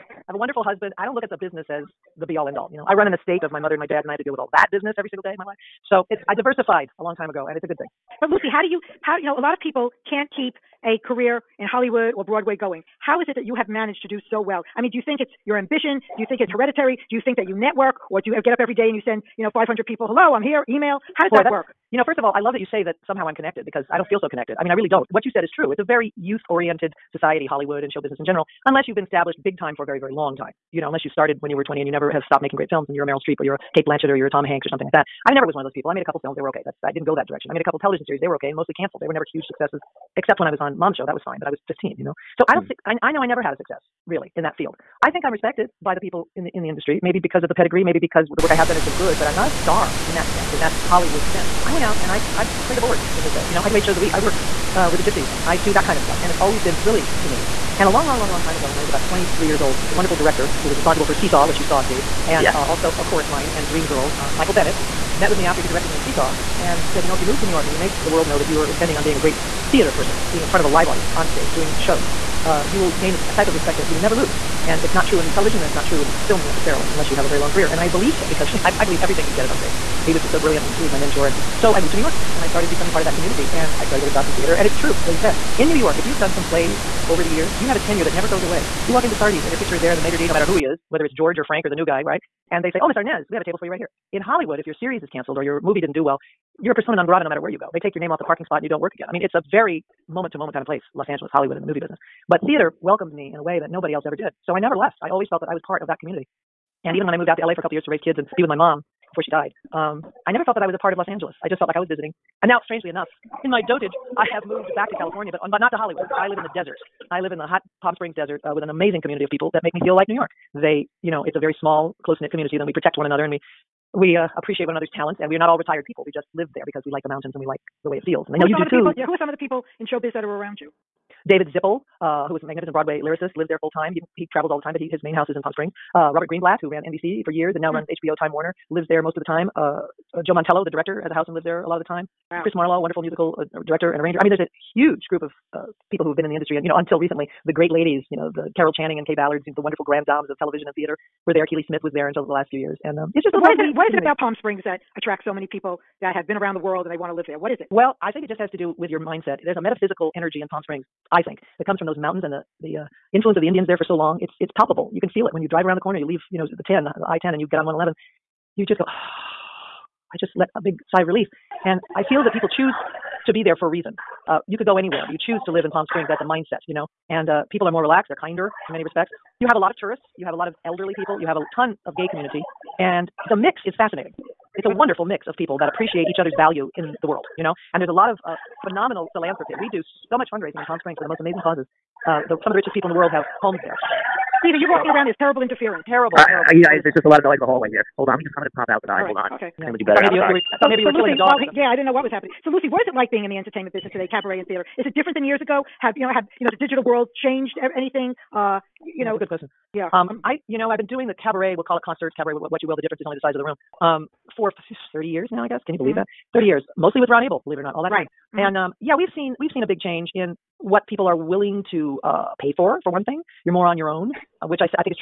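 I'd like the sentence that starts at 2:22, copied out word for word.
Chris Marlowe, wonderful musical uh, director and arranger.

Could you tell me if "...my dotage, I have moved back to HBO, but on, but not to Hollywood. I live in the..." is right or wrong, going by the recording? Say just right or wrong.
wrong.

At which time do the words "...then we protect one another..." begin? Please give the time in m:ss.
2:02.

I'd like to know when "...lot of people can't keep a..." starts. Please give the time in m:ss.
0:09.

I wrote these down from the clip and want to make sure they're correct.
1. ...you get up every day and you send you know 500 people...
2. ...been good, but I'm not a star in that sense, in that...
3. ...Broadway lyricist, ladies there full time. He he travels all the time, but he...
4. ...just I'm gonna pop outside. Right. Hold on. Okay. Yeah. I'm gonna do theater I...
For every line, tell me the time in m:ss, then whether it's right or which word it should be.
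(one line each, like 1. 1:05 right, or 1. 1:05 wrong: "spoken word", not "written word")
1. 0:18 right
2. 0:48 right
3. 2:12 wrong: "lives", not "ladies"
4. 3:18 wrong: "better", not "theater".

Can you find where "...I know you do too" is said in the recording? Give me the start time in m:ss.
2:08.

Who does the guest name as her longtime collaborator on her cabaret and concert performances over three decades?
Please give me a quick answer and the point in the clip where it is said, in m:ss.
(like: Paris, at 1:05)
Ron Abel, at 3:37.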